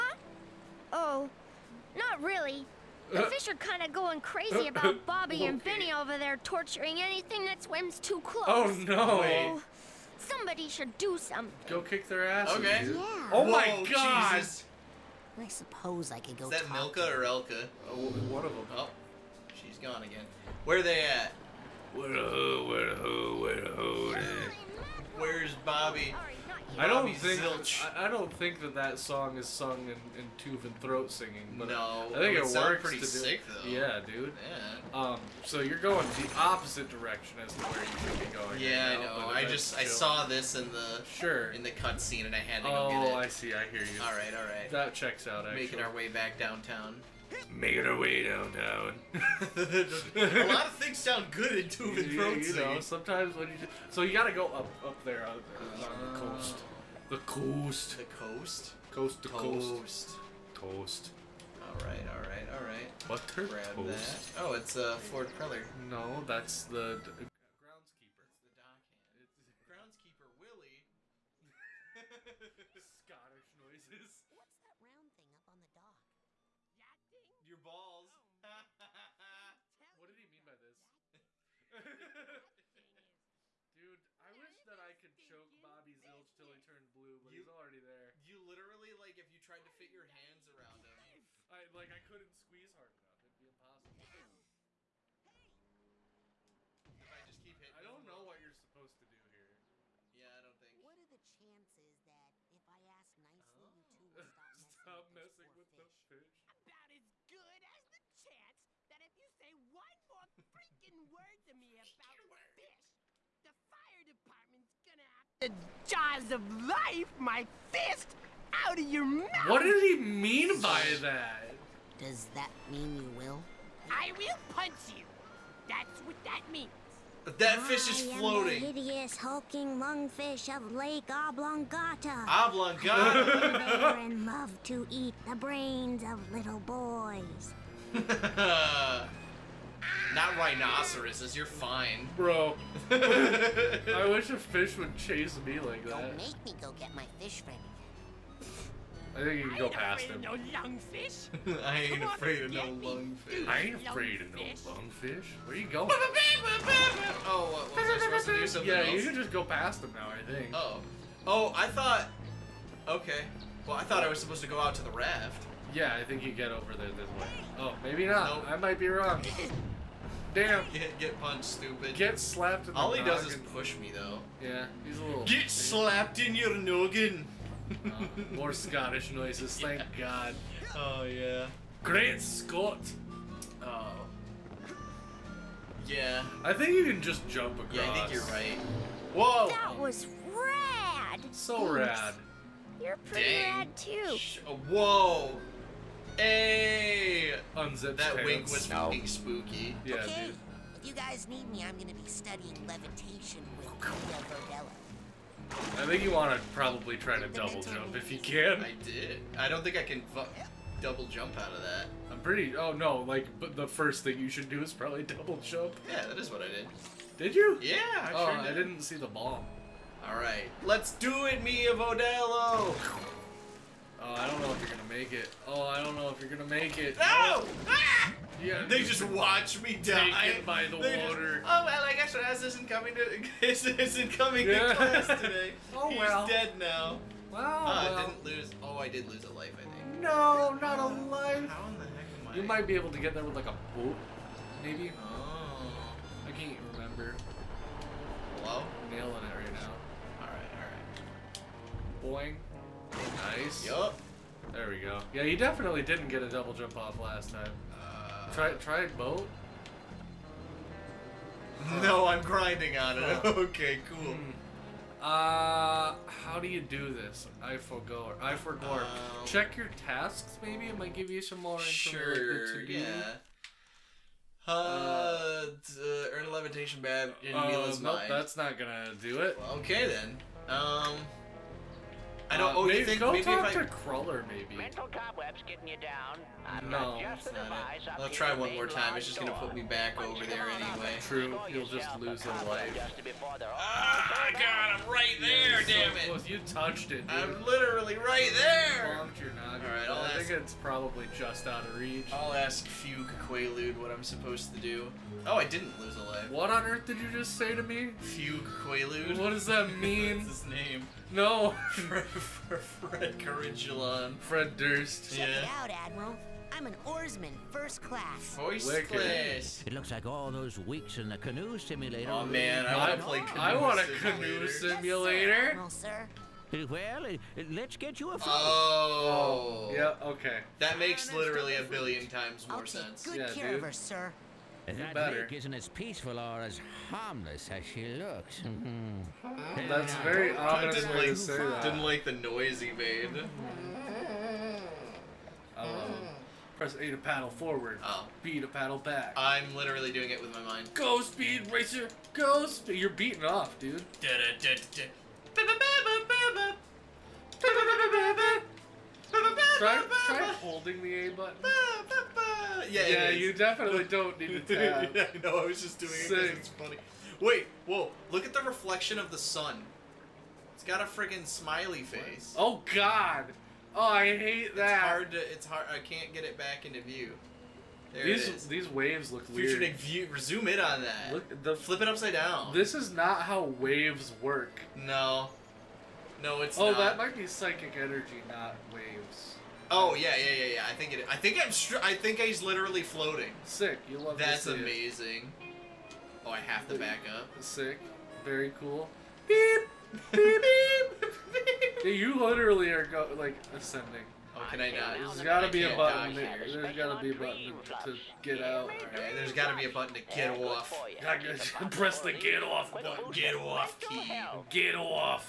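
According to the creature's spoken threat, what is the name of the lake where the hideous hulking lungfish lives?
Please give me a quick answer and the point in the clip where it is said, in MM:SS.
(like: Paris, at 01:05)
Lake Oblongata, at 02:10.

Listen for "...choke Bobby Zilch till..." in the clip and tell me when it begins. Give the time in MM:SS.
01:25.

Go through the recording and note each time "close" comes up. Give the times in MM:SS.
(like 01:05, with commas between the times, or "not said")
00:08, 04:56.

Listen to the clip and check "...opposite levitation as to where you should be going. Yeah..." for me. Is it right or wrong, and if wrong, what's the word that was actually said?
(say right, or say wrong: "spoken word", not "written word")
wrong: "direction", not "levitation".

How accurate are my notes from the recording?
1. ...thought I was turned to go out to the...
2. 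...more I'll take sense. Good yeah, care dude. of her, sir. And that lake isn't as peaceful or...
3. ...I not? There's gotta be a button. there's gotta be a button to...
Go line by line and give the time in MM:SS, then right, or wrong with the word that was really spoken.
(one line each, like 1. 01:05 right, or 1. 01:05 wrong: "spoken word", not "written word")
1. 02:43 wrong: "supposed", not "turned"
2. 05:32 right
3. 06:44 right.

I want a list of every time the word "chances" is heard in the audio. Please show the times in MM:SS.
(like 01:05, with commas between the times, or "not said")
01:41, 01:48.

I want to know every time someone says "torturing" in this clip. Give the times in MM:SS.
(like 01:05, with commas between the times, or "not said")
00:06.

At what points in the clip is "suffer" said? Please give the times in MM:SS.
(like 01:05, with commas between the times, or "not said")
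not said.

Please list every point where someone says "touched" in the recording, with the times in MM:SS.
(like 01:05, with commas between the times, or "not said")
04:56.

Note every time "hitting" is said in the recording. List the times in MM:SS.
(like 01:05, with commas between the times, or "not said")
01:37.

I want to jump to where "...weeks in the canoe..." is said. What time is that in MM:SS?
05:20.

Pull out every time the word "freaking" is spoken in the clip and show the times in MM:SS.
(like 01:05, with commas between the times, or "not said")
01:50.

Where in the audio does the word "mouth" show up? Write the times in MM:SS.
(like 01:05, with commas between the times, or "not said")
01:59.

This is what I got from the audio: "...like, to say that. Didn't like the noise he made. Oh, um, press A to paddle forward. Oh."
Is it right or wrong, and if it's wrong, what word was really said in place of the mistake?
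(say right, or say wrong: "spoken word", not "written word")
right.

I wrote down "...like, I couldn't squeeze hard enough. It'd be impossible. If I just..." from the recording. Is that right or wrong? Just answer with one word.
right.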